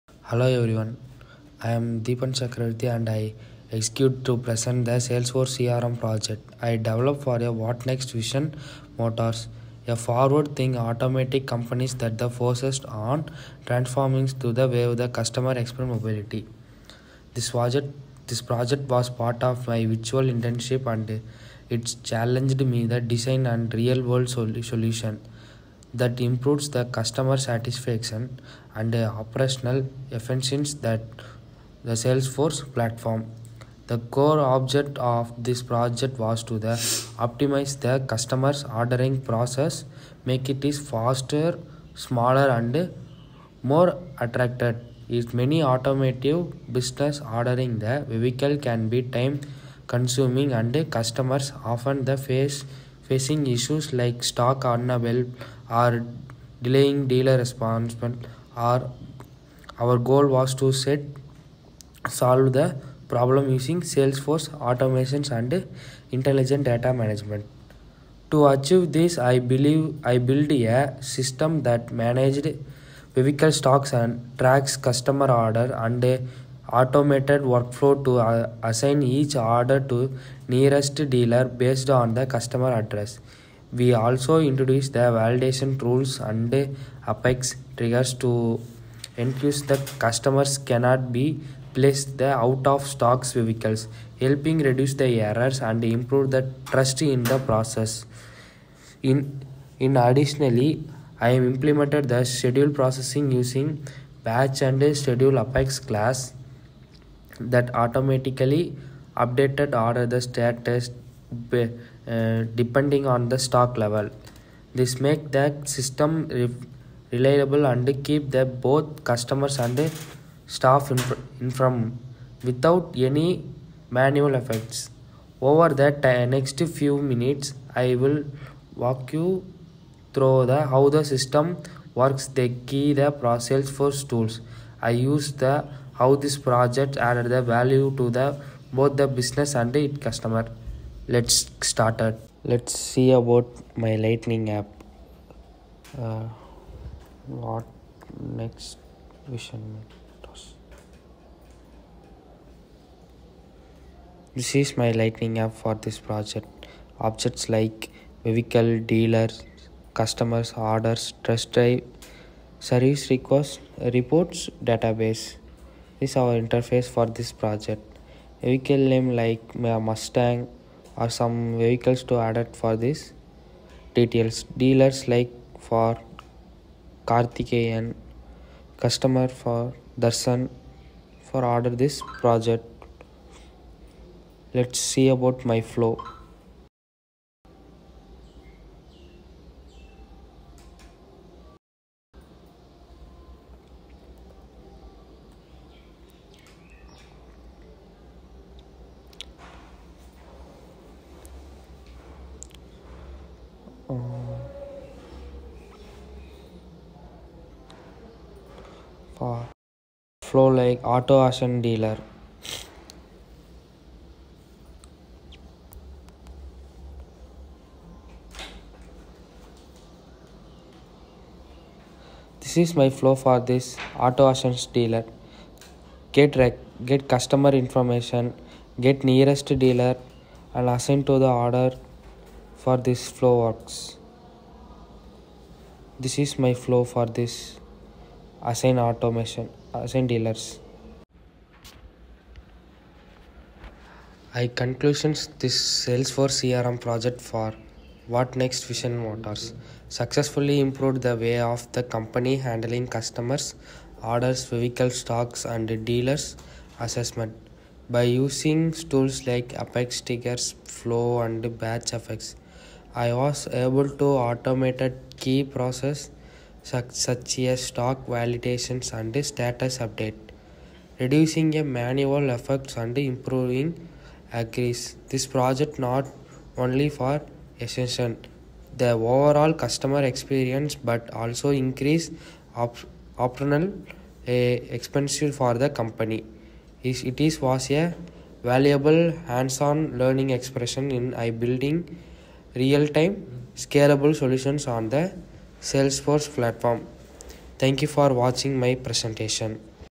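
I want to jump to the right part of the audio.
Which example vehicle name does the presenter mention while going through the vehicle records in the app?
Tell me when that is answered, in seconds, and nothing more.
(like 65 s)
169 s.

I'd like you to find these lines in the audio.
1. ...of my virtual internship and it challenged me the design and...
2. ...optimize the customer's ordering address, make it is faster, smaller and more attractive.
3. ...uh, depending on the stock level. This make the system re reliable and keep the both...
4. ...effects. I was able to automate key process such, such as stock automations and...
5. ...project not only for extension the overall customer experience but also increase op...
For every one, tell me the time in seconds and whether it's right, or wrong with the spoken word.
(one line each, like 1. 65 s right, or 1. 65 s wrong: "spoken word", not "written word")
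1. 19 s right
2. 37 s wrong: "process", not "address"
3. 112 s right
4. 261 s wrong: "validations", not "automations"
5. 275 s right.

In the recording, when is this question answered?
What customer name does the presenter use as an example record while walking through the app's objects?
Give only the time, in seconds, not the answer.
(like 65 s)
179 s.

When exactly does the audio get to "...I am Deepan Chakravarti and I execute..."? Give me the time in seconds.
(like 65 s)
1 s.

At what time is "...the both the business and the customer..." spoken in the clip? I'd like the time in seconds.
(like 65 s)
138 s.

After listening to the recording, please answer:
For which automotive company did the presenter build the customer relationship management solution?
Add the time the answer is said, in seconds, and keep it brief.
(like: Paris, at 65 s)
WhatNext Vision Motors, at 248 s.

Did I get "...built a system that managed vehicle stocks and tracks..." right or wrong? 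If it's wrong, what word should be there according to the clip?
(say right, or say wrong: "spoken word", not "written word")
right.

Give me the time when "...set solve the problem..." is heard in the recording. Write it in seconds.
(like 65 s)
60 s.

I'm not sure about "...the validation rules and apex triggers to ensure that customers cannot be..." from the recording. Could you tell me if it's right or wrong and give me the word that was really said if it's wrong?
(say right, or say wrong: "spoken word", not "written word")
right.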